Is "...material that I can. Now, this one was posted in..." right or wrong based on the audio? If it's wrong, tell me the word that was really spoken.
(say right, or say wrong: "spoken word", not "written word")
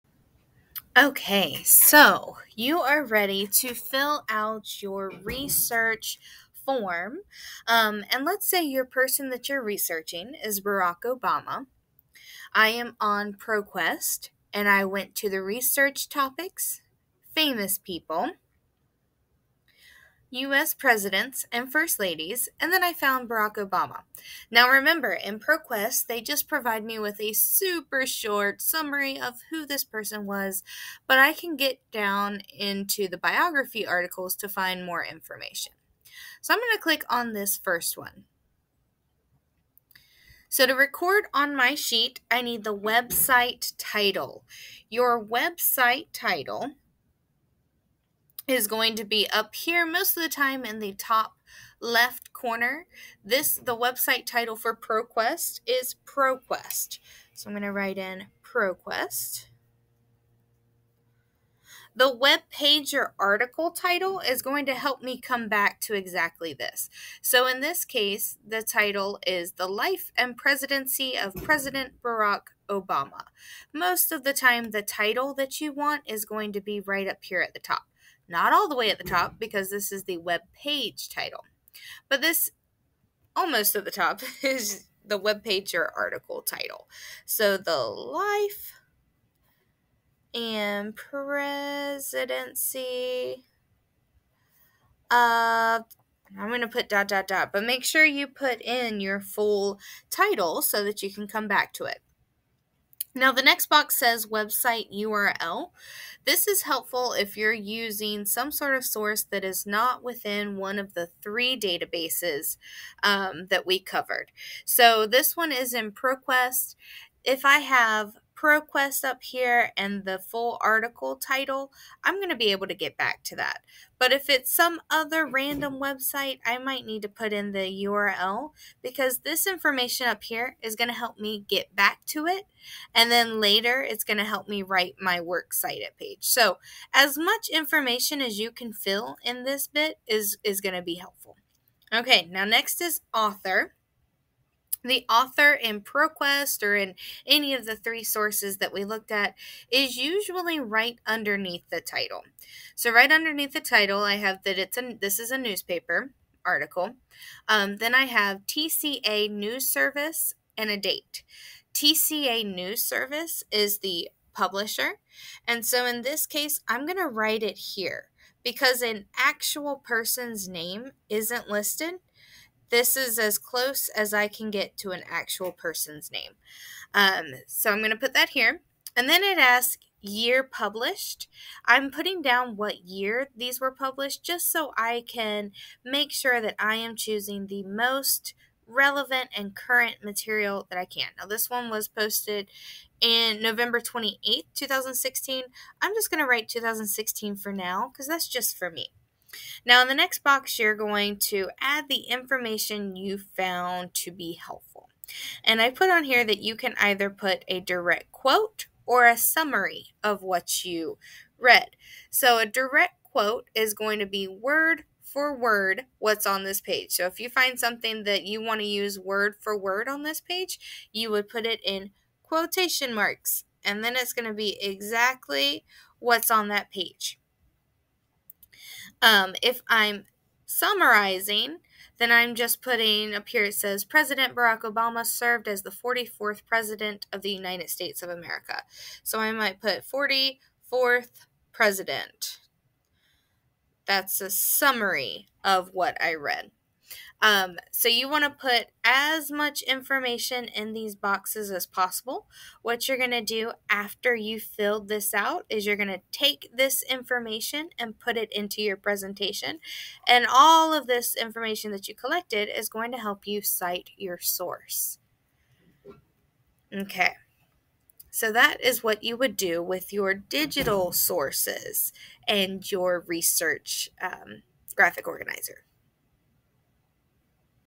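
right.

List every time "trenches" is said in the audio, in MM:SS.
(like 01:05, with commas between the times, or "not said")
not said.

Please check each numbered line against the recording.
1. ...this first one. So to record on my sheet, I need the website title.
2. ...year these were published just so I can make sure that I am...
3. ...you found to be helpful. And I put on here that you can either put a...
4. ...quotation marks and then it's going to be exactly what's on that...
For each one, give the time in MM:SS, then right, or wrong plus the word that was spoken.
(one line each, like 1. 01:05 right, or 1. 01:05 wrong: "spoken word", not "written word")
1. 00:37 right
2. 03:02 right
3. 03:22 right
4. 03:42 right.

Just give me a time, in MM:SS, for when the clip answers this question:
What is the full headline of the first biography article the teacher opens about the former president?
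01:09.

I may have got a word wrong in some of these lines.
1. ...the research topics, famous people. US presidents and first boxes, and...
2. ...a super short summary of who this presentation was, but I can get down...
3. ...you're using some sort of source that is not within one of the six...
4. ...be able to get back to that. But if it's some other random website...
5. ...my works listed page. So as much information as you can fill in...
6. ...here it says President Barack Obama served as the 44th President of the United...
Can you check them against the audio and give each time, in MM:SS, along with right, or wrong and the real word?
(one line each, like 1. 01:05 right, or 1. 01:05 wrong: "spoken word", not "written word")
1. 00:15 wrong: "ladies", not "boxes"
2. 00:27 wrong: "person", not "presentation"
3. 01:47 wrong: "three", not "six"
4. 02:02 right
5. 02:14 wrong: "cited", not "listed"
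6. 03:53 right.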